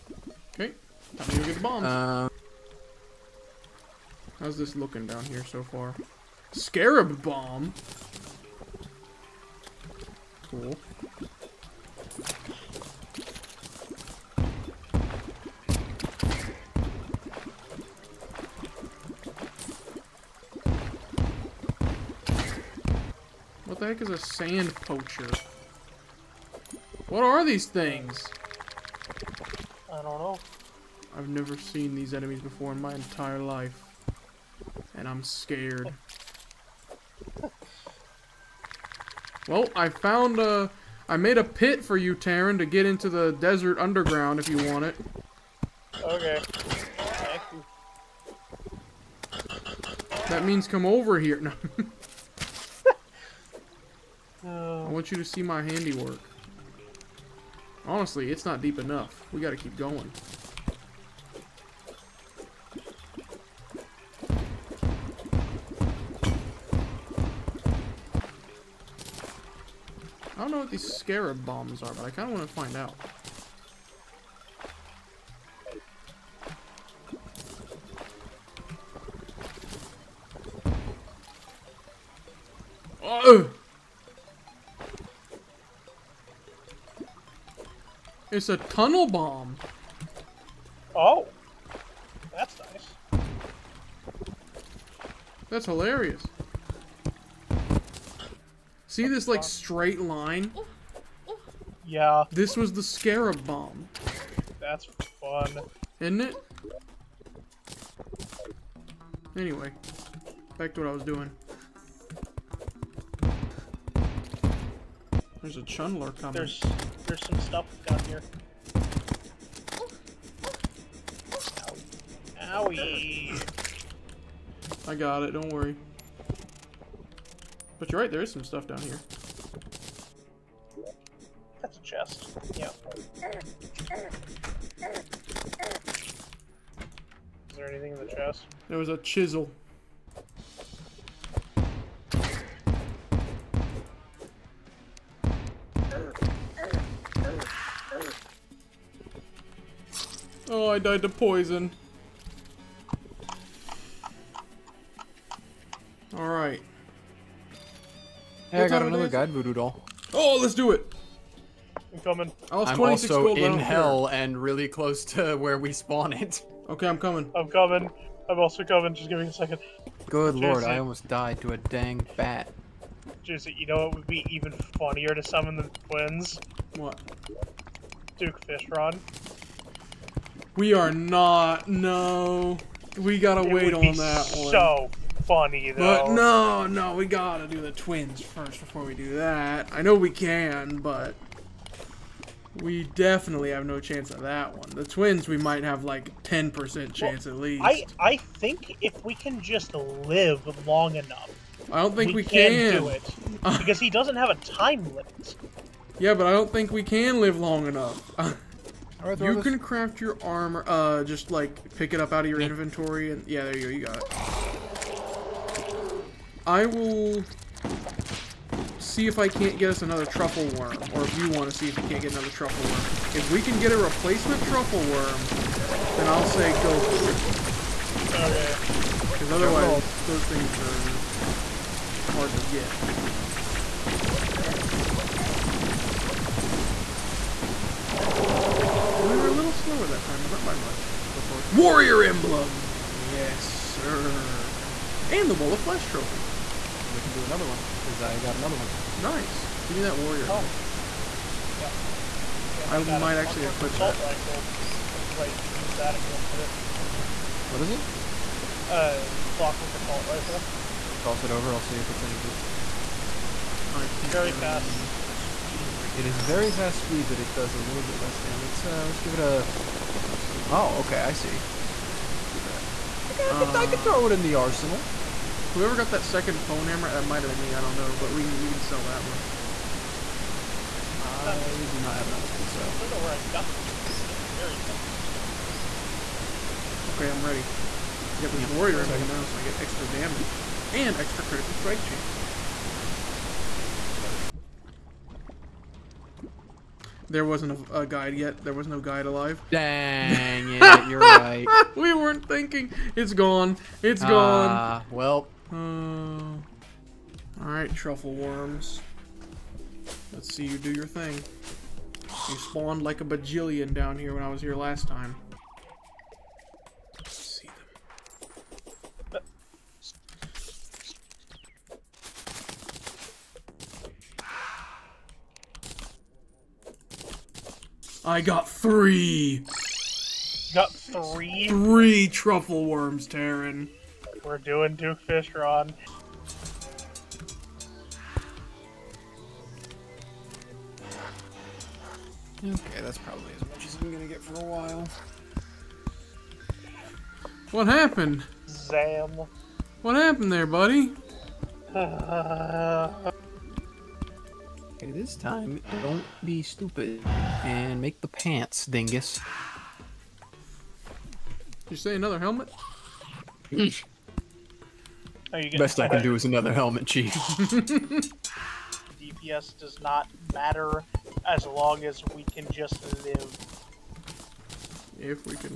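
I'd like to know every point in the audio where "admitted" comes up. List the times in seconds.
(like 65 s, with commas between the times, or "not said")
not said.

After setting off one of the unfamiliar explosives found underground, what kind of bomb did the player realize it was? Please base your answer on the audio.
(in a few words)
Tunnel bomb.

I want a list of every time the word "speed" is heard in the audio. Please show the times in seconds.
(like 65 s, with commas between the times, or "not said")
266 s.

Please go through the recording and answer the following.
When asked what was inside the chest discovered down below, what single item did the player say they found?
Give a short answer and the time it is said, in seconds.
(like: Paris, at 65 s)
Chisel, at 138 s.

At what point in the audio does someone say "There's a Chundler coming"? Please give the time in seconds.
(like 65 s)
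115 s.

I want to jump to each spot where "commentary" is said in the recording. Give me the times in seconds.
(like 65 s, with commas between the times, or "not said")
not said.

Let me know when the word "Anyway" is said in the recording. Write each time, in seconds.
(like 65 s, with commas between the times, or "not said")
109 s.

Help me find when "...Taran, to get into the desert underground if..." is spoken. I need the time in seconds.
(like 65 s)
42 s.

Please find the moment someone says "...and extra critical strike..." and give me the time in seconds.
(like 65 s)
290 s.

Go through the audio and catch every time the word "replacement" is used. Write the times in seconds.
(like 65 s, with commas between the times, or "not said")
223 s.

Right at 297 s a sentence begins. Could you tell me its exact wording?
There wasn't a, a, guide yet.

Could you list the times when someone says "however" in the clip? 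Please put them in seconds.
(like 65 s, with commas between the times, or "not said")
not said.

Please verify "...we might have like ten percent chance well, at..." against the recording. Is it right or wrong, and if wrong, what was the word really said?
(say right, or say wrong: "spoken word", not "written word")
right.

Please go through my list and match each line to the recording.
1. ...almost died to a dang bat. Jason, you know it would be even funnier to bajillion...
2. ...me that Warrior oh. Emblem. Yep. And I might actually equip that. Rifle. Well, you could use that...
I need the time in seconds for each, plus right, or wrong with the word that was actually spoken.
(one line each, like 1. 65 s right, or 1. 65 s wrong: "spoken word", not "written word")
1. 170 s wrong: "summon", not "bajillion"
2. 249 s right.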